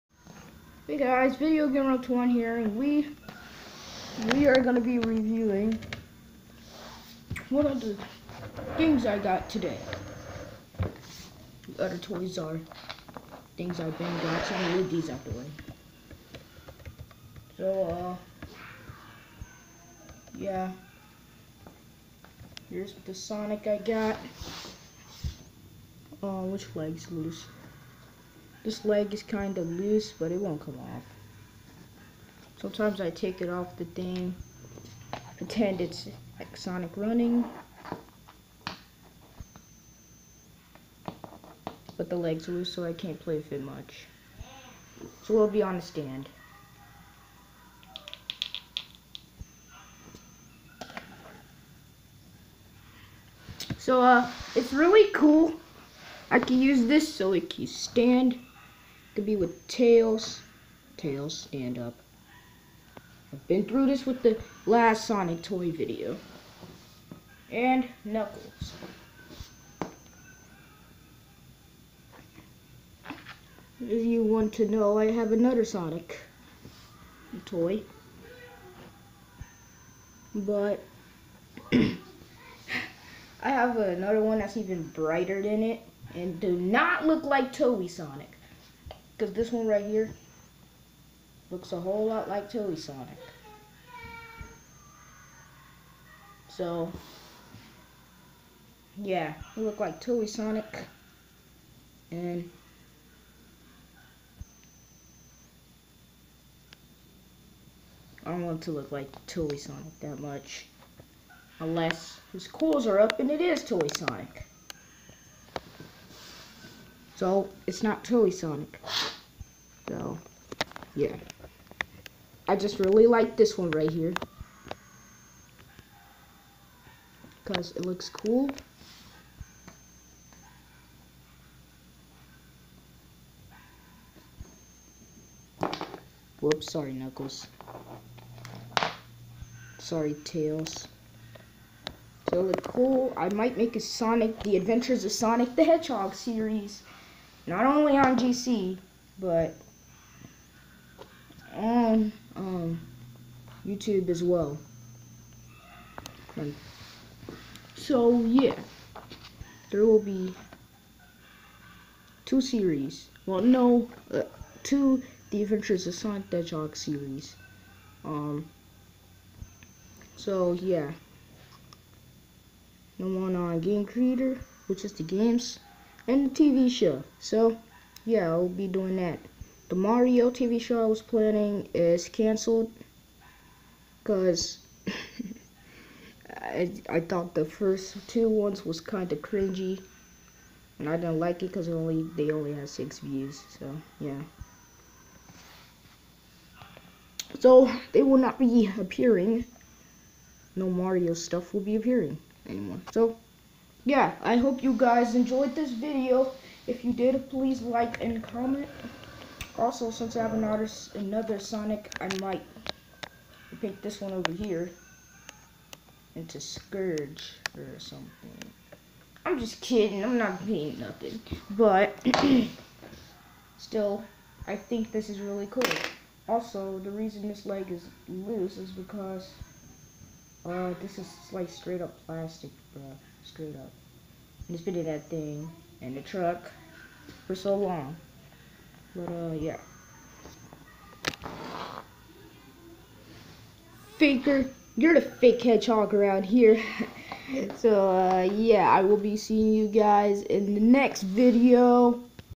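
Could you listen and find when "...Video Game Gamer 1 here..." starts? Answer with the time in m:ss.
0:01.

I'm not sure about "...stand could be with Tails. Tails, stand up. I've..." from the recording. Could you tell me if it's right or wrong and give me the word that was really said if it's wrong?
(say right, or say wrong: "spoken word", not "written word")
right.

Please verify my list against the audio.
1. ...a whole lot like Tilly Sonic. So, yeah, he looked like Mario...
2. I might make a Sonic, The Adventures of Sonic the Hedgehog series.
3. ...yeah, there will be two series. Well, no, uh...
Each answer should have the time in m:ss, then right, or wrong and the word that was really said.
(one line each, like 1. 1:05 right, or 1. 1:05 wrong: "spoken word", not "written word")
1. 1:31 wrong: "Tilly", not "Mario"
2. 2:23 right
3. 2:38 right.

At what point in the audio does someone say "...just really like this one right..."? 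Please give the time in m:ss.
2:02.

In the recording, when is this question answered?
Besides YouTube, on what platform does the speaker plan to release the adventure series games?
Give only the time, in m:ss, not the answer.
2:53.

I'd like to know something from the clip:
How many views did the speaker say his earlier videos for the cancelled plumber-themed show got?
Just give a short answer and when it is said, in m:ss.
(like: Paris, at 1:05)
6, at 3:12.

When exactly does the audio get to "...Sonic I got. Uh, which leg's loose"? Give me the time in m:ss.
0:23.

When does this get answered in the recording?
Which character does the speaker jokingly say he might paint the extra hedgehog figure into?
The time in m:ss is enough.
3:36.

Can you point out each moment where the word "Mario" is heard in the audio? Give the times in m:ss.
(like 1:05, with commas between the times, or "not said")
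2:59, 3:20.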